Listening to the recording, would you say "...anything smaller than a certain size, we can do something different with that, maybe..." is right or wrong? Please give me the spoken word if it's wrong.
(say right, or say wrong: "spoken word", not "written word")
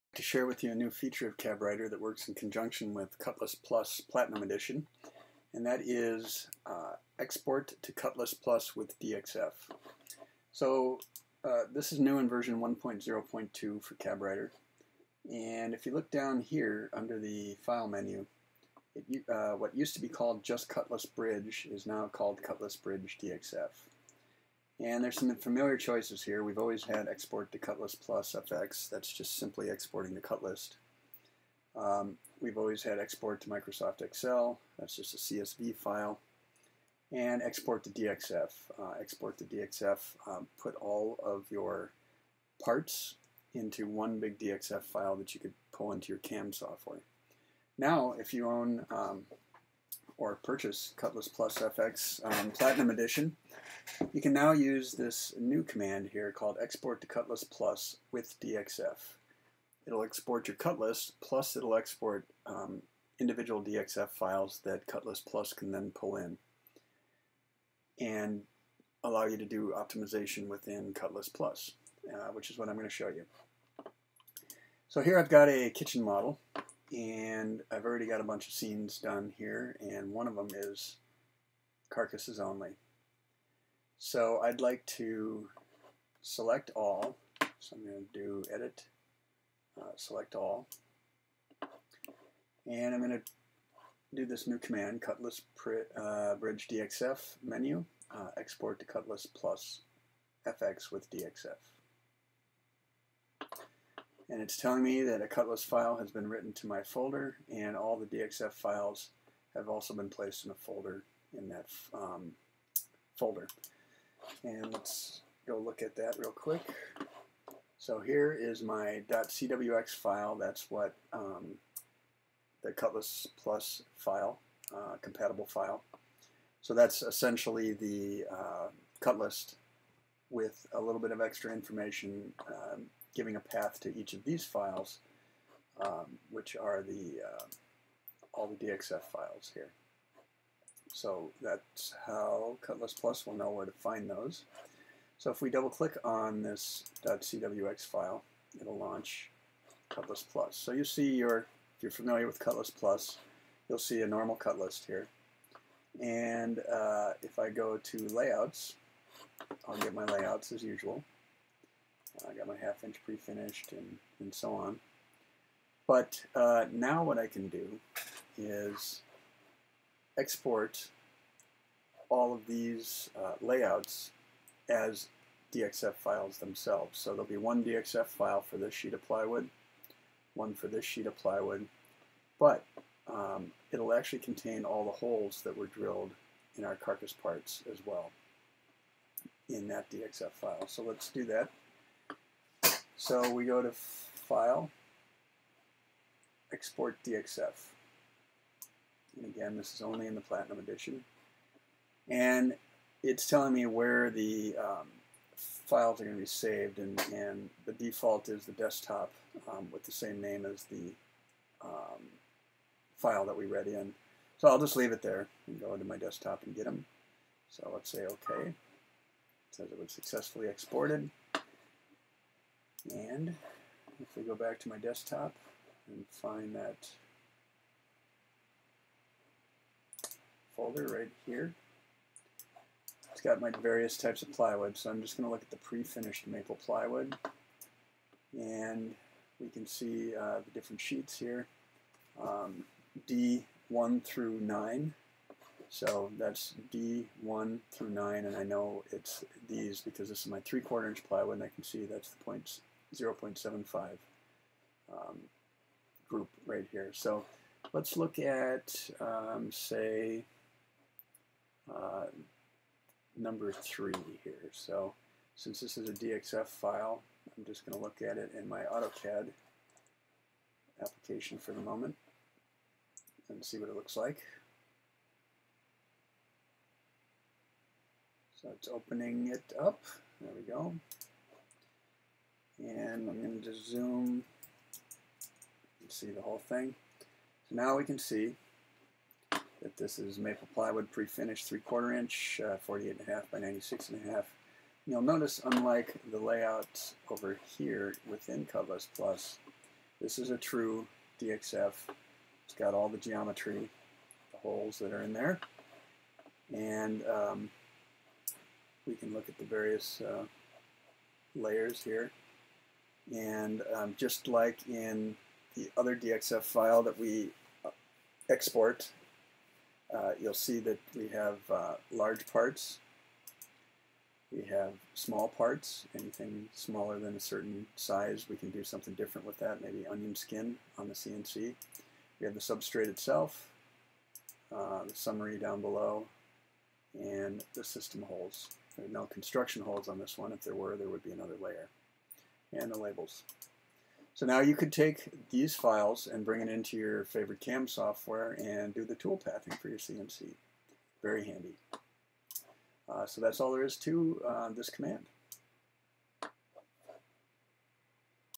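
right.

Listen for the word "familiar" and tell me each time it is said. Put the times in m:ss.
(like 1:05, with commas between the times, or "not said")
0:25, 2:31.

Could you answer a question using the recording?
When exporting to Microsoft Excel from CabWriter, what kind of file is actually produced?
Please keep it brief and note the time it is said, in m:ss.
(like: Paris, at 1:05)
CSV file, at 0:35.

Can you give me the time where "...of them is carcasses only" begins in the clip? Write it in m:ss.
1:20.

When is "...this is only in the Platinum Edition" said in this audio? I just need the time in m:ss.
3:19.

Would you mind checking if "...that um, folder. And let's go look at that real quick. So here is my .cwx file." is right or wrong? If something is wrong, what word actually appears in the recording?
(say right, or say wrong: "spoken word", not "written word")
right.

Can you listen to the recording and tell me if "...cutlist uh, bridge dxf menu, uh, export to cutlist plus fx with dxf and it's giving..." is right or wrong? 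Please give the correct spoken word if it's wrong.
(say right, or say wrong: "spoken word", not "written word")
wrong: "telling", not "giving".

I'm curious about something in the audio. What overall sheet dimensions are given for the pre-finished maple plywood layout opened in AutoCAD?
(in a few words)
48.5 by 96.5.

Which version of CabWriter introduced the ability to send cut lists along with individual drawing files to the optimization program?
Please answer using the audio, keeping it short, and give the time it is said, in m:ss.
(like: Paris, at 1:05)
1.0.2, at 0:12.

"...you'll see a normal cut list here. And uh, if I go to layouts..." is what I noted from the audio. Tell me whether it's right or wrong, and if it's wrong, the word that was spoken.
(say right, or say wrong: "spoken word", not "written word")
right.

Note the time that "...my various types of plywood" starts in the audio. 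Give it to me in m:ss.
3:53.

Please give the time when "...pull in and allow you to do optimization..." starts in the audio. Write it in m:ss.
1:05.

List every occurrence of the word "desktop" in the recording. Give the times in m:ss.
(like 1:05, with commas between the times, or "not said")
3:28, 3:35, 3:44.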